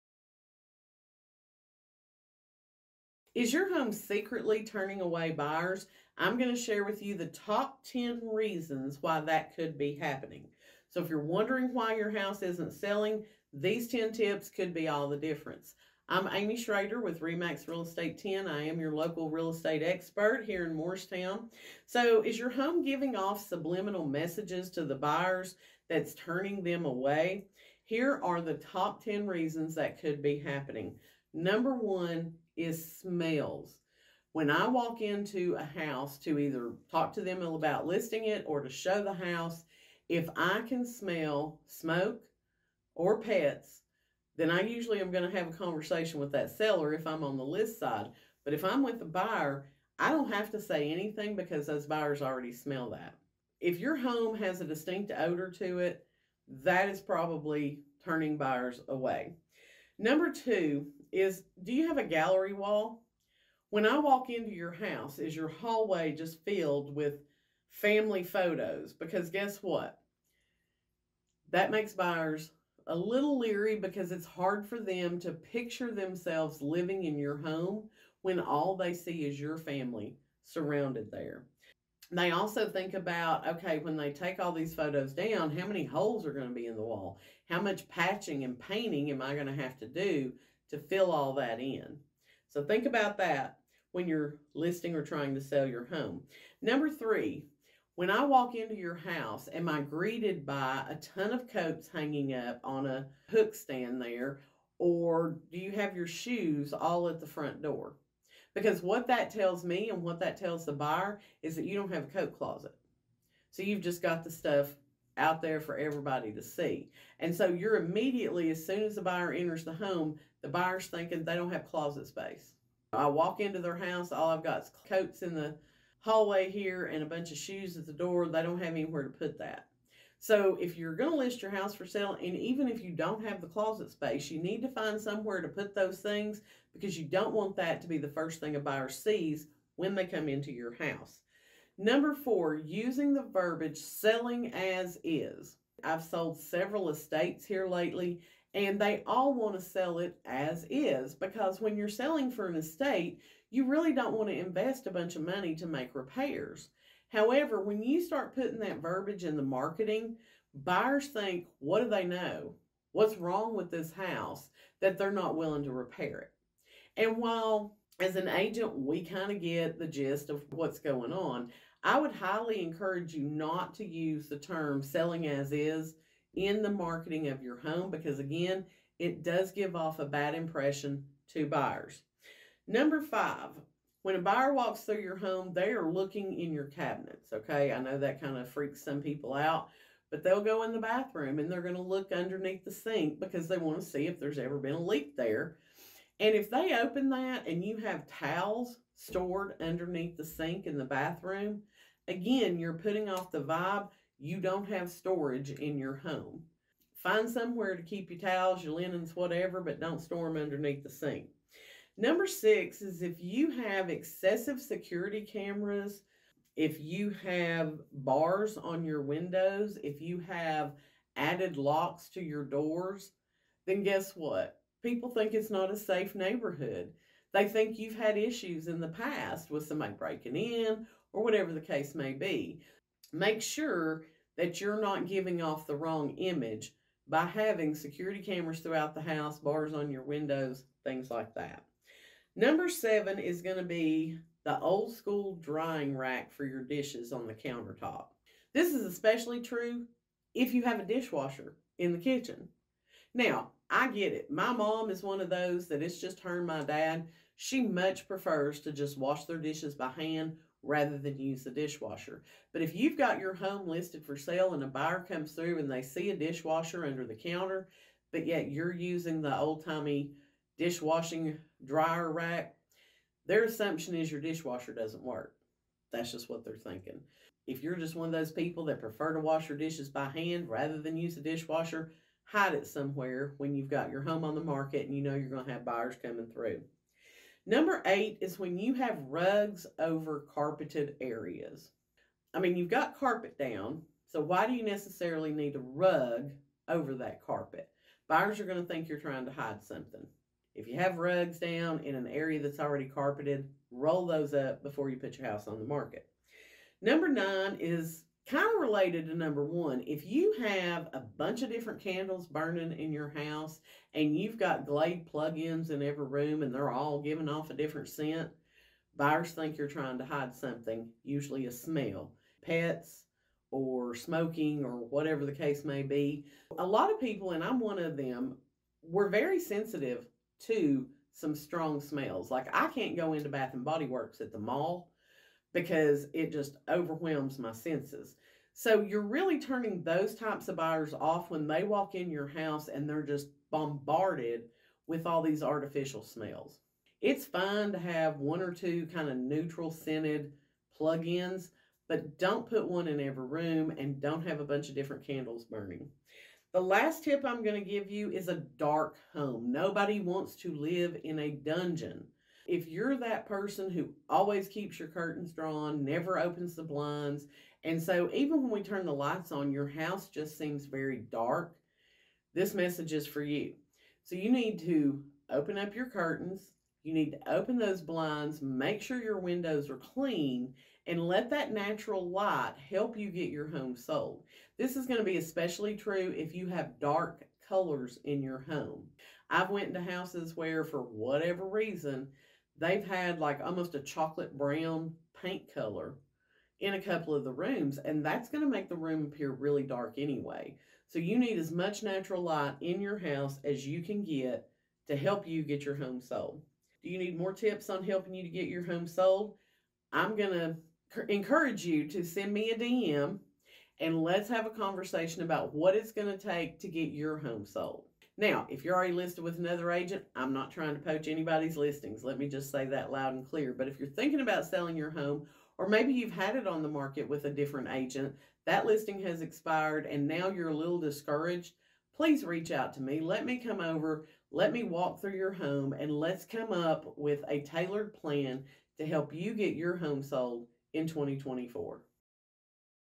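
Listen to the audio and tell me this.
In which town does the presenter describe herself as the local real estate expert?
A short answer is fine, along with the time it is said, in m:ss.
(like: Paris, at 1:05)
Morristown, at 0:20.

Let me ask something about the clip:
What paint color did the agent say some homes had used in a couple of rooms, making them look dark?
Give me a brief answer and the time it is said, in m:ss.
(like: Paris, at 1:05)
Chocolate brown, at 6:33.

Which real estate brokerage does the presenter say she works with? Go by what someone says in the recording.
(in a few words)
Remax Real Estate 10.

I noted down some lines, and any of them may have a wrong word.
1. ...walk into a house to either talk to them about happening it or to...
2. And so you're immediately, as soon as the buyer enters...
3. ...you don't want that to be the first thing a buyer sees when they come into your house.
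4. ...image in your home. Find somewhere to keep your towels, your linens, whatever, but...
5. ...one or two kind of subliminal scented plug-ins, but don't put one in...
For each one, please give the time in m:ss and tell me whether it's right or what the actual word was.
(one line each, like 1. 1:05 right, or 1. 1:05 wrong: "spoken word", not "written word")
1. 0:34 wrong: "listing", not "happening"
2. 1:57 right
3. 2:16 right
4. 3:24 wrong: "storage", not "image"
5. 5:48 wrong: "neutral", not "subliminal".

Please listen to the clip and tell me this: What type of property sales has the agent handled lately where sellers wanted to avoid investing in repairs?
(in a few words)
Estates.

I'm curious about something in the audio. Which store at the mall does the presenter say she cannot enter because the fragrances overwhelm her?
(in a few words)
Bath and Body Works.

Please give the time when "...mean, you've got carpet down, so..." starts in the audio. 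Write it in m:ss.
4:52.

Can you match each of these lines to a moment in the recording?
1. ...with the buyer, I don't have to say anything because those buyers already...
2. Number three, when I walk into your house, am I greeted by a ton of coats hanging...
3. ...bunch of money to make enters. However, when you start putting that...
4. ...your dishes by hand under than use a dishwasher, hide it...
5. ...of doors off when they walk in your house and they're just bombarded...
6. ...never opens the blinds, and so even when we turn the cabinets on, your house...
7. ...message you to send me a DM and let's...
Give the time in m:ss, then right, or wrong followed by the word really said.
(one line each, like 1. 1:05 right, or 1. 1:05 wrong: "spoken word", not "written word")
1. 0:48 right
2. 1:36 right
3. 2:34 wrong: "repairs", not "enters"
4. 4:39 wrong: "rather", not "under"
5. 5:40 wrong: "buyers", not "doors"
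6. 6:05 wrong: "lights", not "cabinets"
7. 6:51 wrong: "encourage", not "message".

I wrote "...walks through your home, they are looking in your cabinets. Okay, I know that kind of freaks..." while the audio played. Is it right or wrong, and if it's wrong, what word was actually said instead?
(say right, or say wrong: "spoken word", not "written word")
right.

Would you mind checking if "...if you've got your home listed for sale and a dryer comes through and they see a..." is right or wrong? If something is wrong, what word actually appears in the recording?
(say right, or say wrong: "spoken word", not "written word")
wrong: "buyer", not "dryer".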